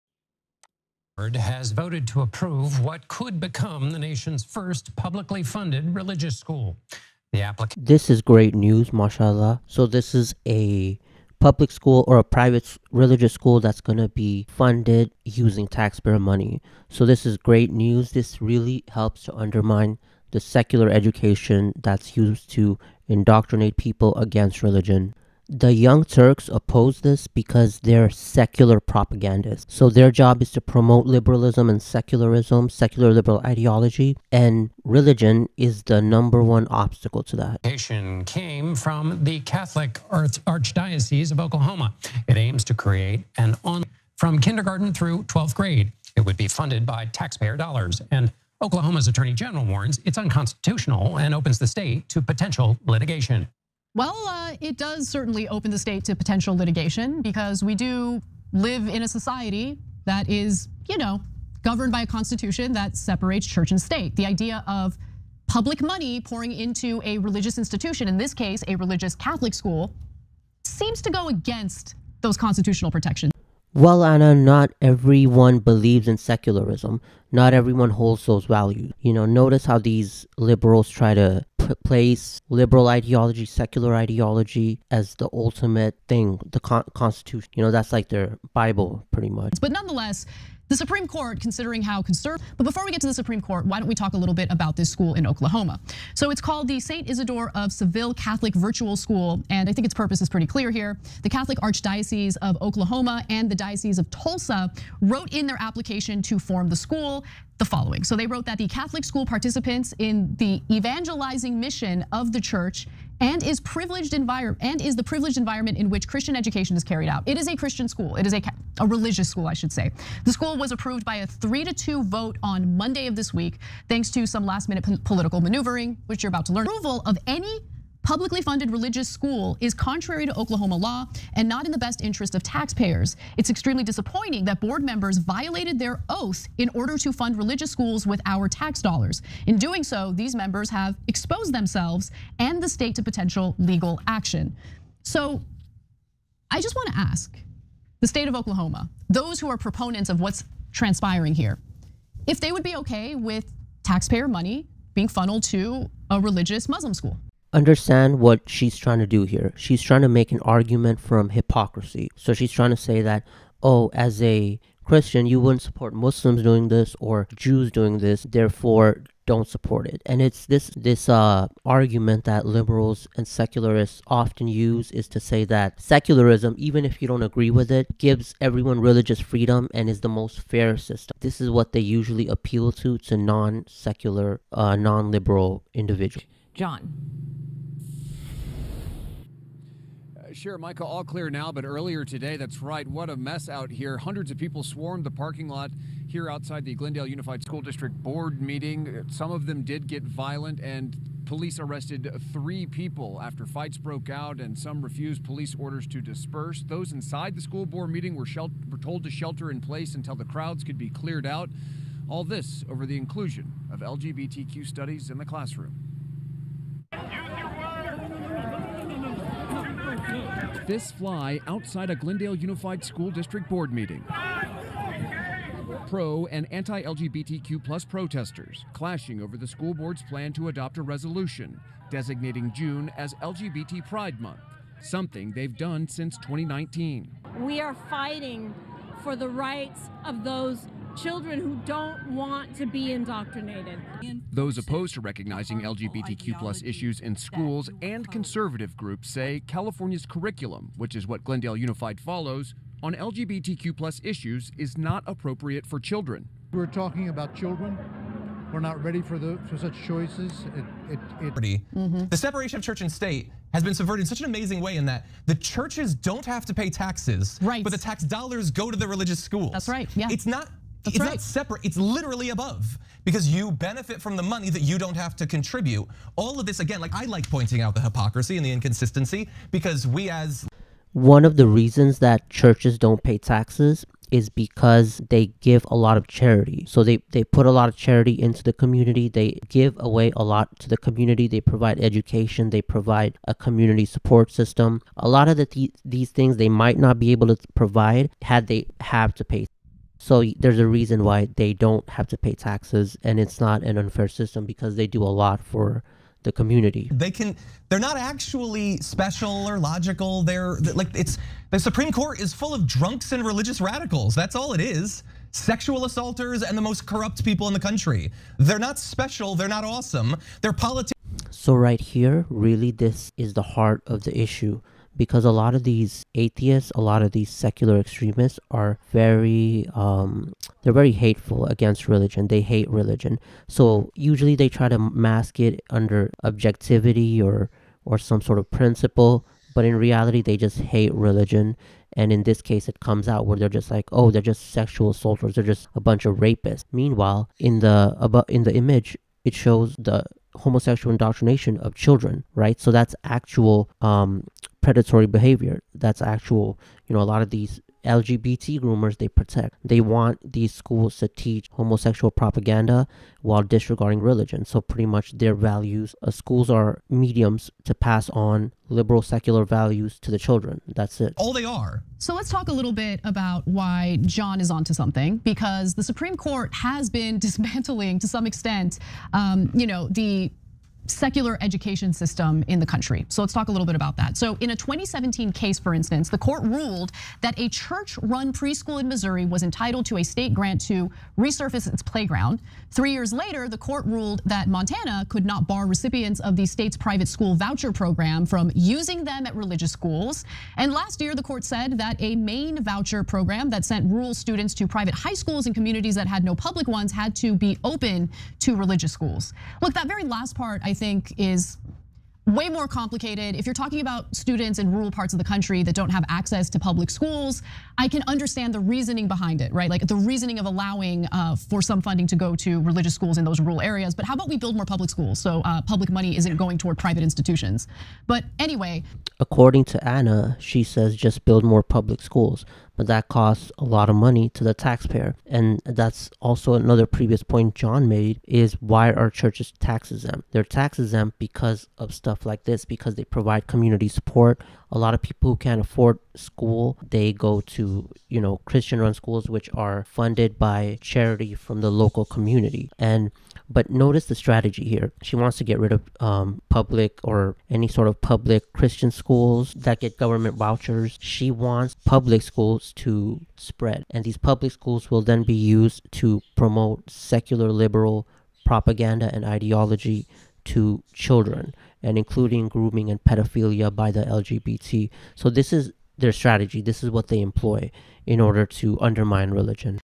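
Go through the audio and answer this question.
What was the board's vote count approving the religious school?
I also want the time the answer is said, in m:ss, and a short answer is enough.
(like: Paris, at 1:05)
3 to 2, at 2:01.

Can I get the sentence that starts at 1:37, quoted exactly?
Isidore of Seville Catholic Virtual School, and I think its purpose is pretty clear here.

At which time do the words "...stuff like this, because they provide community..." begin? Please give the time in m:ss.
7:21.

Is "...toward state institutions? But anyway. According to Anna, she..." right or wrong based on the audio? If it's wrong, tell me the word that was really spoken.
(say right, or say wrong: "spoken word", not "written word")
wrong: "private", not "state".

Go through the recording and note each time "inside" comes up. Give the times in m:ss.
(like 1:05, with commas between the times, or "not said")
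3:26.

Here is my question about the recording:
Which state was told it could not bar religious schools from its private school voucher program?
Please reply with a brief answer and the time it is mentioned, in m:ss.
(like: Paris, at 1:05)
Montana, at 6:34.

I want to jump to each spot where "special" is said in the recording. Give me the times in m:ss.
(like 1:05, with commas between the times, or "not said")
5:08, 5:18.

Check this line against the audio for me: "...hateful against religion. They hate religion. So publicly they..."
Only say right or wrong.
wrong.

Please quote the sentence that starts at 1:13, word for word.
Well, Anna, not everyone believes in secularism not everyone holds those values.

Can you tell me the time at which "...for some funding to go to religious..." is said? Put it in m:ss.
7:01.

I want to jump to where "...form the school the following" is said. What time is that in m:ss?
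1:46.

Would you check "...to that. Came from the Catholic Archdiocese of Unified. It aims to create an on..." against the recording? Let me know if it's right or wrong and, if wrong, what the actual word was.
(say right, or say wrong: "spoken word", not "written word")
wrong: "Oklahoma", not "Unified".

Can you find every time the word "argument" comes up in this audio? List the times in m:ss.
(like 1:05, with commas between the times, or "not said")
2:40, 2:51.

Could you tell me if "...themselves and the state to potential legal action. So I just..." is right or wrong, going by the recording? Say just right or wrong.
right.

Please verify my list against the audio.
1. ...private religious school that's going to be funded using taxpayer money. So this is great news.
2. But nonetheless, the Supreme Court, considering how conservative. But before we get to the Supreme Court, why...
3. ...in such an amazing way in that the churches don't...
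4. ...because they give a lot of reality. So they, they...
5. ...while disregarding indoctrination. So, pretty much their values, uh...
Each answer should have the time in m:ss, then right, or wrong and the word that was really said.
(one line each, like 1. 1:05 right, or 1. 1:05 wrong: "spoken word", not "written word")
1. 0:12 right
2. 1:29 right
3. 4:24 right
4. 4:44 wrong: "charity", not "reality"
5. 6:03 wrong: "religion", not "indoctrination".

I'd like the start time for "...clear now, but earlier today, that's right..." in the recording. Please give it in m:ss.
3:11.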